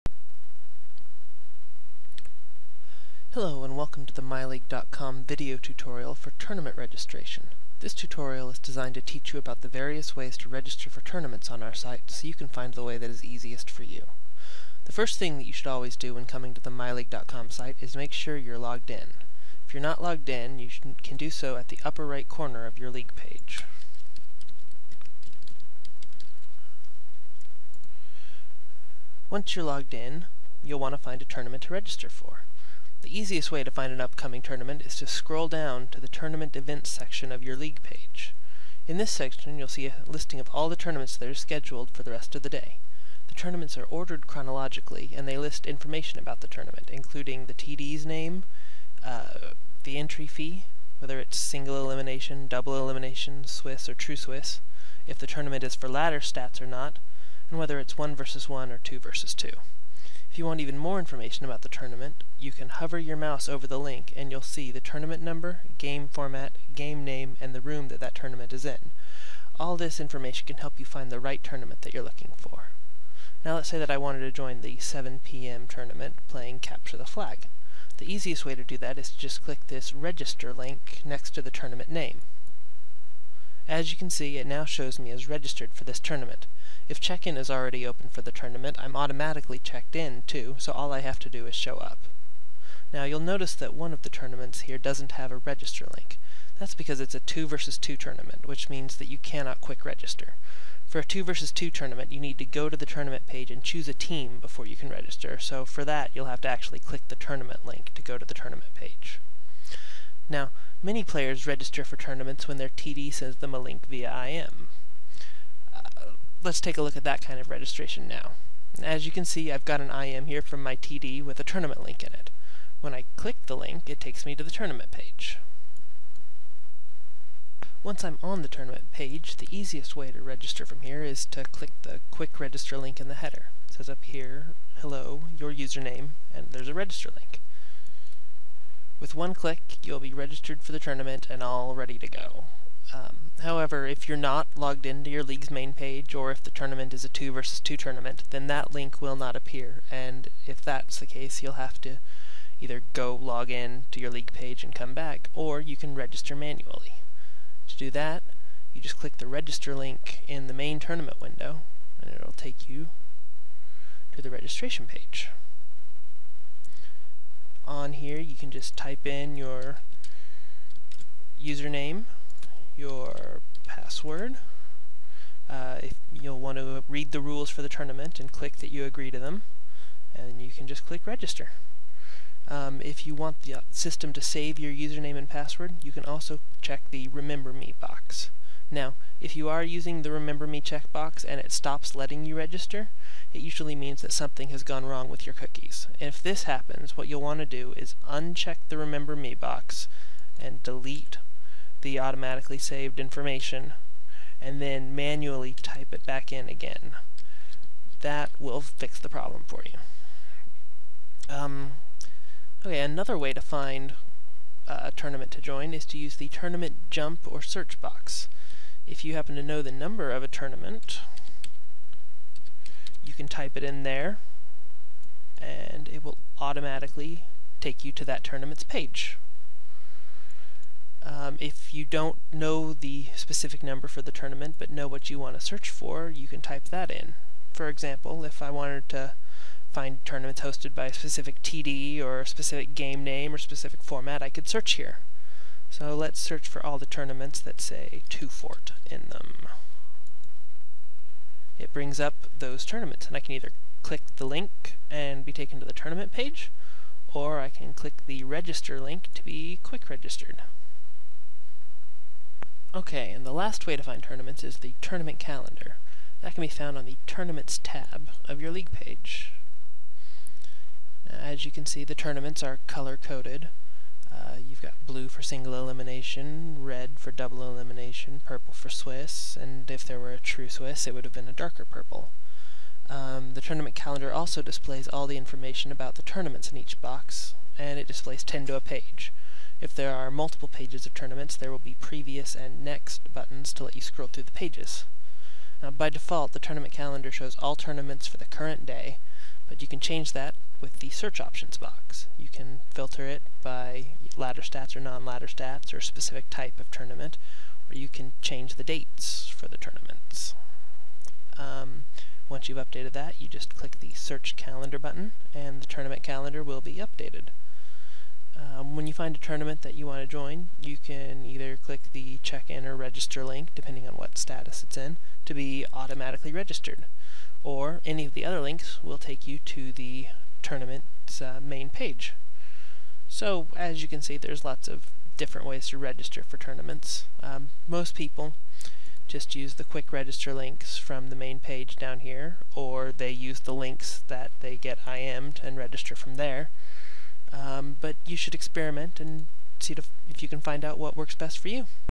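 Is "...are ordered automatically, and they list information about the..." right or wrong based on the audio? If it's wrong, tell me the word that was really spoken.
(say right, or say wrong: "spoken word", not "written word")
wrong: "chronologically", not "automatically".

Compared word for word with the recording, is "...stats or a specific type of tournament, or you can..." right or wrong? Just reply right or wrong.
right.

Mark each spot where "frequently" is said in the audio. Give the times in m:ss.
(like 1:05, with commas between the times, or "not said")
not said.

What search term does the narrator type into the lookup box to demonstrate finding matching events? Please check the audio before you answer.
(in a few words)
Two Fort.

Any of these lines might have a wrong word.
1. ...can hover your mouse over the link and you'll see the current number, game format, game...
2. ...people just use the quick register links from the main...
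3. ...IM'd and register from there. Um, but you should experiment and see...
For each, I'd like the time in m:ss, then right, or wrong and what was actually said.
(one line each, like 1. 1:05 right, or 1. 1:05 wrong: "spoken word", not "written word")
1. 1:02 wrong: "tournament", not "current"
2. 5:37 right
3. 5:44 right.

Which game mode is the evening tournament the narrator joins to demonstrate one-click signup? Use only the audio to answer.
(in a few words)
Capture the Flag.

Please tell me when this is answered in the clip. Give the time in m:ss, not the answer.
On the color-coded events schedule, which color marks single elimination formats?
4:34.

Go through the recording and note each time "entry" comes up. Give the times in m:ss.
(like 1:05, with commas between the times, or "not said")
0:49.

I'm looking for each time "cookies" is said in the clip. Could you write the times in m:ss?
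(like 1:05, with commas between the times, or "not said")
3:15.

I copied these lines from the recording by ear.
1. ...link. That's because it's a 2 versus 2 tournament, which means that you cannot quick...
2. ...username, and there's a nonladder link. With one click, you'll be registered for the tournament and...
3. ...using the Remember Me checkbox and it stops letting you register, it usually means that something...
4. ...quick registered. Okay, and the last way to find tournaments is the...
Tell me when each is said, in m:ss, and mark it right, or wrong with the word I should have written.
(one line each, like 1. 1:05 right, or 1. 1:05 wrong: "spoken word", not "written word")
1. 1:35 right
2. 2:15 wrong: "register", not "nonladder"
3. 3:09 right
4. 4:19 right.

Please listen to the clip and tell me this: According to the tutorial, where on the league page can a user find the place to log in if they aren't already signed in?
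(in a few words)
upper right corner.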